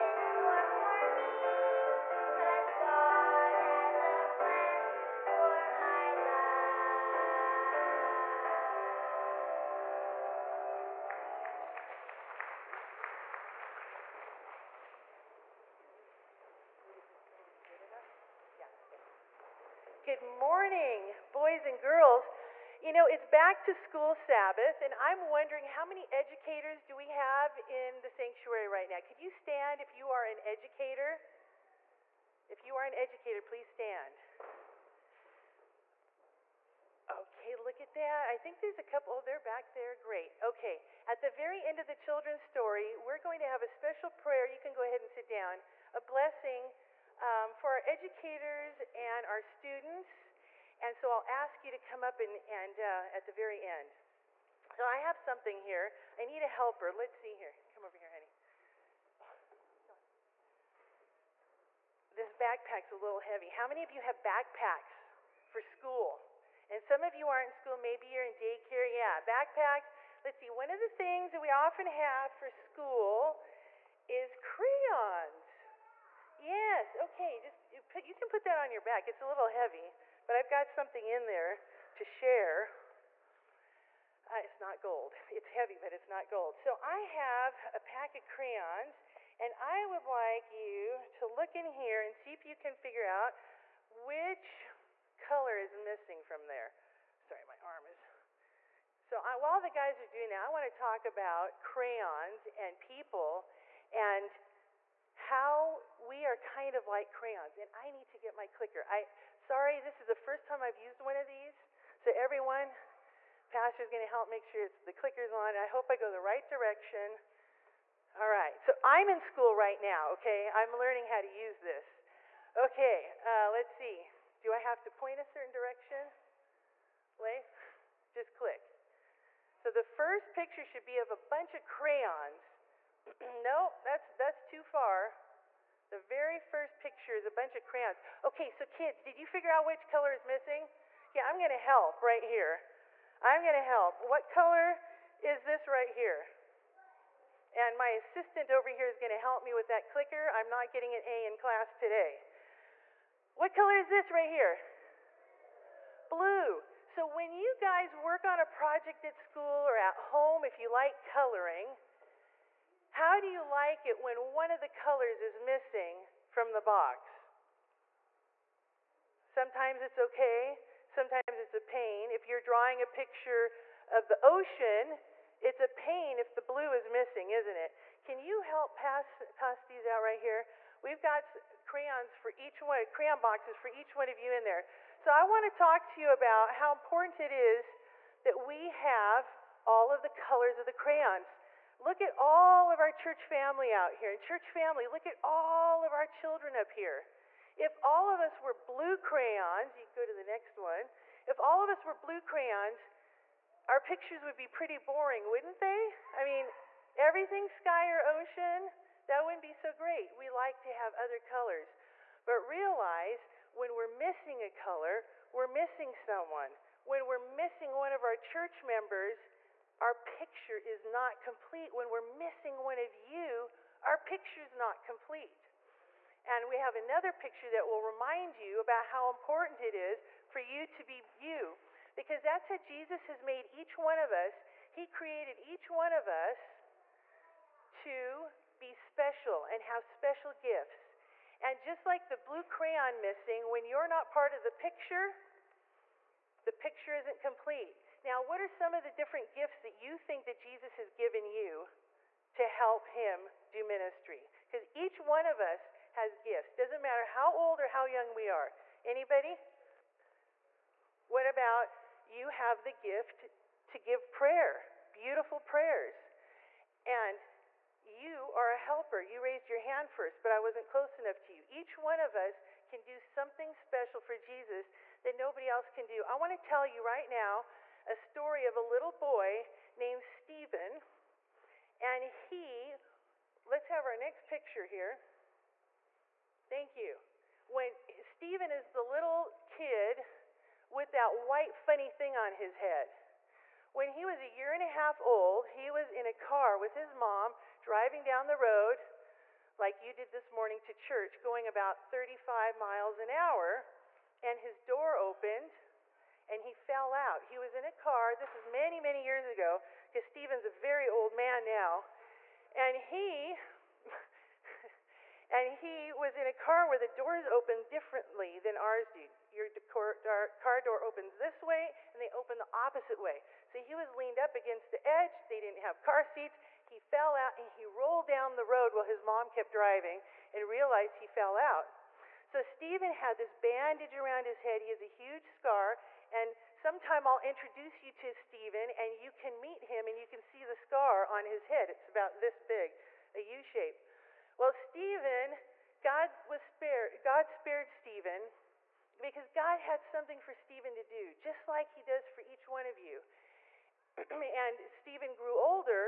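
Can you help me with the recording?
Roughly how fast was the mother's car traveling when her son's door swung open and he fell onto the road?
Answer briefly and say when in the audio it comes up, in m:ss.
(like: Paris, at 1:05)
35 miles an hour, at 5:01.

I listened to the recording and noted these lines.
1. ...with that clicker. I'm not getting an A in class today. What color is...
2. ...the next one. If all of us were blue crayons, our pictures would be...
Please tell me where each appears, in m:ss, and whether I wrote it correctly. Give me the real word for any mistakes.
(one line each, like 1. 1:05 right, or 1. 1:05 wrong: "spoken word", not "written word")
1. 2:29 right
2. 3:20 right.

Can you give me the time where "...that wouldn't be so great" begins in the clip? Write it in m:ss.
3:29.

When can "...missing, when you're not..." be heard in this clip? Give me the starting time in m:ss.
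4:03.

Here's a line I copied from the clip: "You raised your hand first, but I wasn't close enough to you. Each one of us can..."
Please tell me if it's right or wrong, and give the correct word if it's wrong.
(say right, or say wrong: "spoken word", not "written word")
right.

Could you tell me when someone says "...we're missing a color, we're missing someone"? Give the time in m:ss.
3:33.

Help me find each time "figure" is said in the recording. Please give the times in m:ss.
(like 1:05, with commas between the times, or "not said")
1:32, 2:19.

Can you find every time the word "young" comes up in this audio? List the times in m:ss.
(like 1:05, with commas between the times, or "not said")
4:17.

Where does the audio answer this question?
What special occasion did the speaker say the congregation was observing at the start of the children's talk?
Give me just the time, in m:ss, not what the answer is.
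0:23.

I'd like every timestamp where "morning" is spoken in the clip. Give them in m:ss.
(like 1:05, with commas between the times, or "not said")
0:20, 5:00.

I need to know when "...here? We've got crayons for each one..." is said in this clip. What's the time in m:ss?
3:00.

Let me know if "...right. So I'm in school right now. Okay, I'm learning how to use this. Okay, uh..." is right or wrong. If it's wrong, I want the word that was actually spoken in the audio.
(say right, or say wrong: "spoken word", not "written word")
right.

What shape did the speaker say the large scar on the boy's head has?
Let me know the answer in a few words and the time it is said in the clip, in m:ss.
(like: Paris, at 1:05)
U shape, at 5:43.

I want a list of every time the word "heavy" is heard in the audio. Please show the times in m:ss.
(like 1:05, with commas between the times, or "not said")
1:03, 1:19, 1:25.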